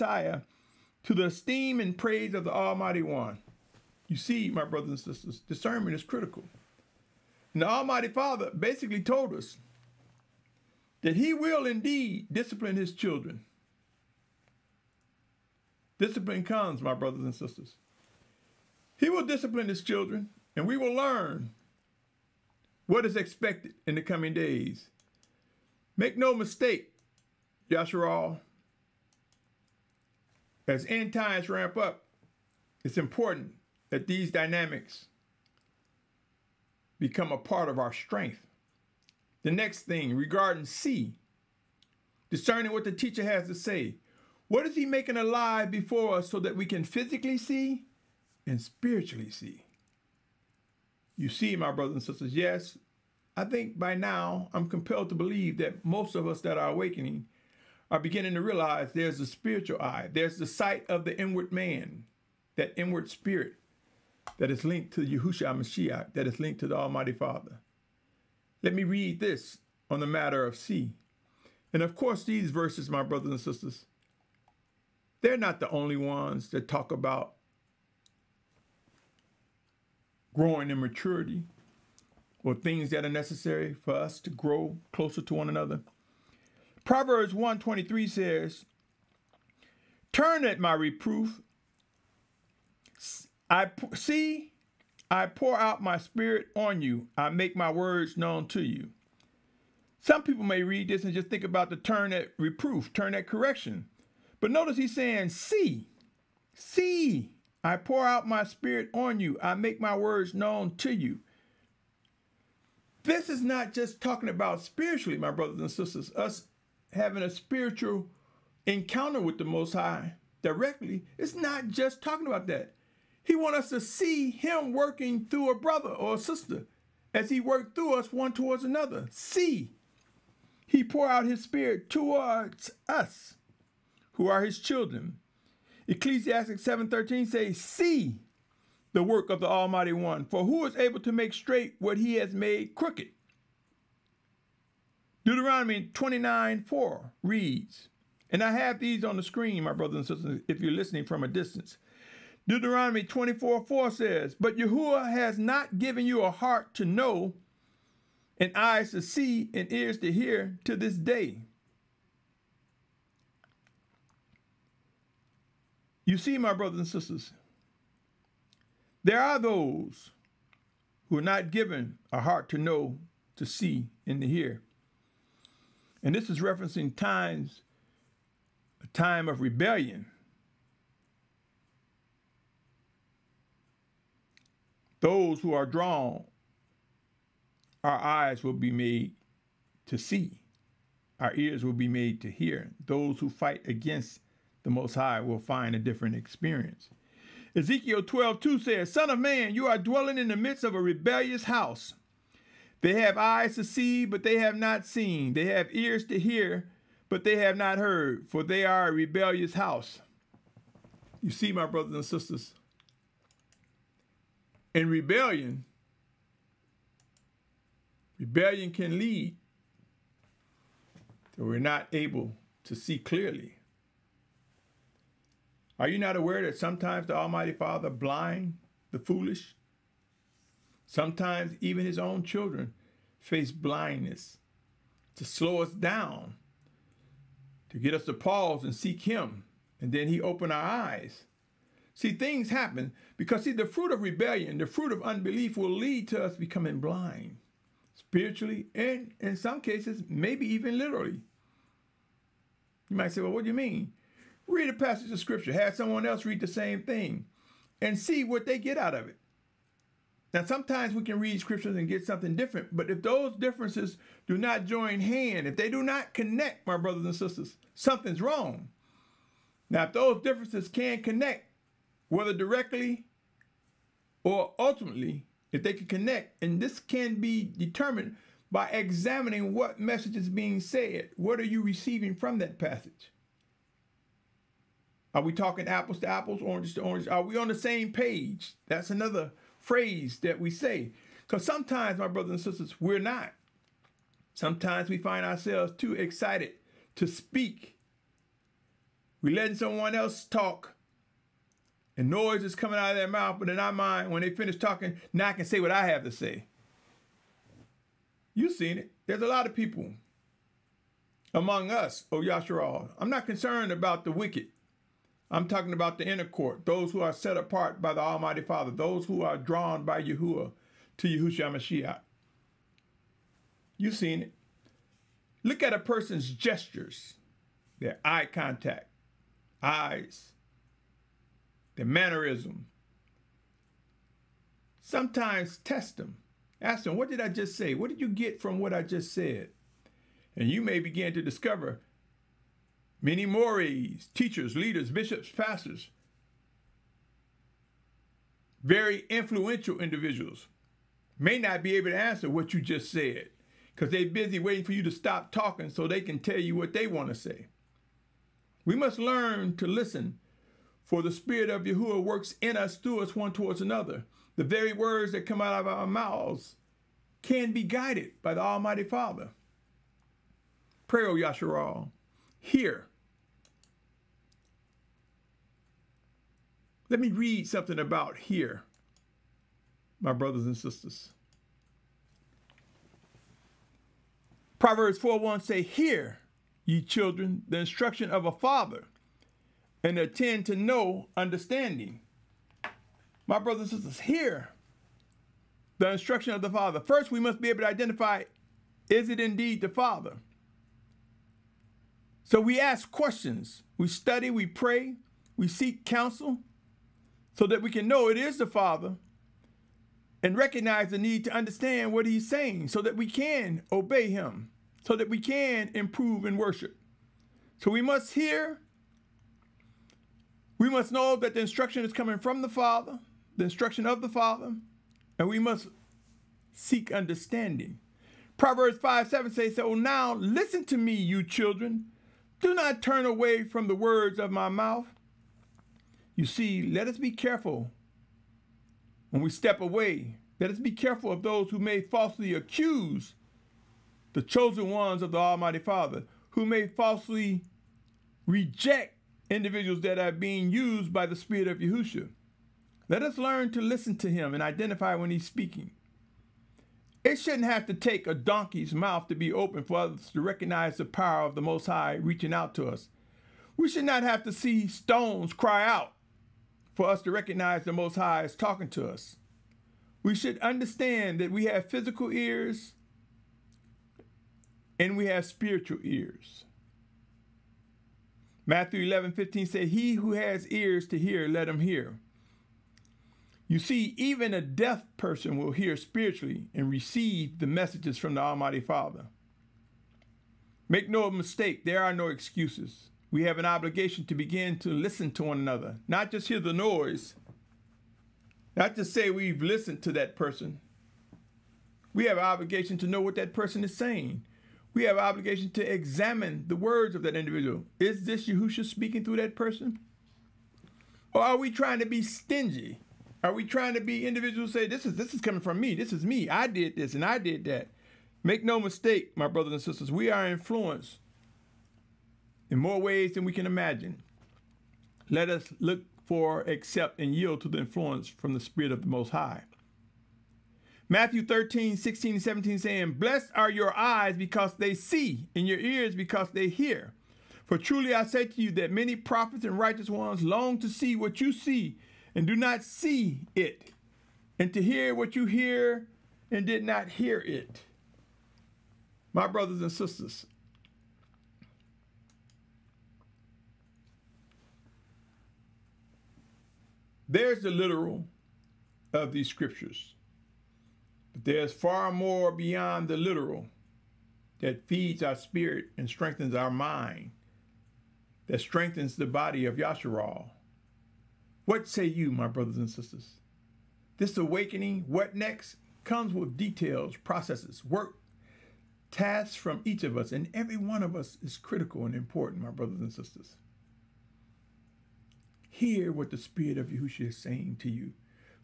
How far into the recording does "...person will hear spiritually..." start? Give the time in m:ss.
8:04.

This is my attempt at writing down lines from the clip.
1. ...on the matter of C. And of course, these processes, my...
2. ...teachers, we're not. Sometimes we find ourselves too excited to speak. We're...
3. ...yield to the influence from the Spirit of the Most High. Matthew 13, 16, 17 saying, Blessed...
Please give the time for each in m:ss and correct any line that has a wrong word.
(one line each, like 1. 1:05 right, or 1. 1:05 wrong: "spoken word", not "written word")
1. 1:09 wrong: "verses", not "processes"
2. 4:52 wrong: "sisters", not "teachers"
3. 8:47 right.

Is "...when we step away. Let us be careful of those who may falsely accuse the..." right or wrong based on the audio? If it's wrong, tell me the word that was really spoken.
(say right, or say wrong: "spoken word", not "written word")
right.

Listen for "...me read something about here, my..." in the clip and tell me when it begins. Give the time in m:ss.
6:17.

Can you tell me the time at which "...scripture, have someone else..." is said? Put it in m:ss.
4:15.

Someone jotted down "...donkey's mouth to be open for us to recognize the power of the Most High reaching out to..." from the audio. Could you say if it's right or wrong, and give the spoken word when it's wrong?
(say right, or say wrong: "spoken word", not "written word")
right.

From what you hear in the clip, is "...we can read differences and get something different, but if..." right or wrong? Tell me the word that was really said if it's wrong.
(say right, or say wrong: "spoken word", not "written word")
wrong: "scriptures", not "differences".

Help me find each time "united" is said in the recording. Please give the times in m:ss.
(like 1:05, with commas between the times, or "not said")
not said.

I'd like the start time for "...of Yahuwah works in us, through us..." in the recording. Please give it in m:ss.
6:01.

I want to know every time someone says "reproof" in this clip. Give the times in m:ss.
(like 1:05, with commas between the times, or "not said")
1:30, 1:42.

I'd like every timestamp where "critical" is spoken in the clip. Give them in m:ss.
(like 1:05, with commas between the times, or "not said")
0:06, 9:41.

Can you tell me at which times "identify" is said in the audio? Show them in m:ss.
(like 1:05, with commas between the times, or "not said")
6:37, 7:34.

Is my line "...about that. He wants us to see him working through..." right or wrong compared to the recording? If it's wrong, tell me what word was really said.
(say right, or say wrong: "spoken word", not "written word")
right.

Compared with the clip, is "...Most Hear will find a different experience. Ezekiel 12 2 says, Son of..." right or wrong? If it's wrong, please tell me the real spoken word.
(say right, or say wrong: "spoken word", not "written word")
wrong: "High", not "Hear".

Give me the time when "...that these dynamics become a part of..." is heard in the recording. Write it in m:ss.
0:33.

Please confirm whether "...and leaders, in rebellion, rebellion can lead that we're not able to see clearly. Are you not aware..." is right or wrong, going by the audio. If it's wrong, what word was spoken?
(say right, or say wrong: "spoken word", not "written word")
wrong: "sisters", not "leaders".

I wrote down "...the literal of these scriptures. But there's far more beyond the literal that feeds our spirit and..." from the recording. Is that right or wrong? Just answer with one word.
right.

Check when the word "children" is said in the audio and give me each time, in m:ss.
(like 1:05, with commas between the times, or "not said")
0:12, 0:19, 2:14, 3:52, 6:26, 7:11.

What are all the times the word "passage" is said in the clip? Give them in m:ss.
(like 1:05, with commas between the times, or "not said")
4:14, 4:42.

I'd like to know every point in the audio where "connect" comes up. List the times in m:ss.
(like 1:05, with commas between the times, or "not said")
4:26, 4:31, 4:35.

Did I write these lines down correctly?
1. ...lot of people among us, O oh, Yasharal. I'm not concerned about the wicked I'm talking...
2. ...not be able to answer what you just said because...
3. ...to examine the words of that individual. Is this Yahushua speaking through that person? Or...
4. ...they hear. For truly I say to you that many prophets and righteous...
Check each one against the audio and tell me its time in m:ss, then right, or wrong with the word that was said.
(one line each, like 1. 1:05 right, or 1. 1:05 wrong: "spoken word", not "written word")
1. 5:09 right
2. 5:51 right
3. 8:25 right
4. 8:56 right.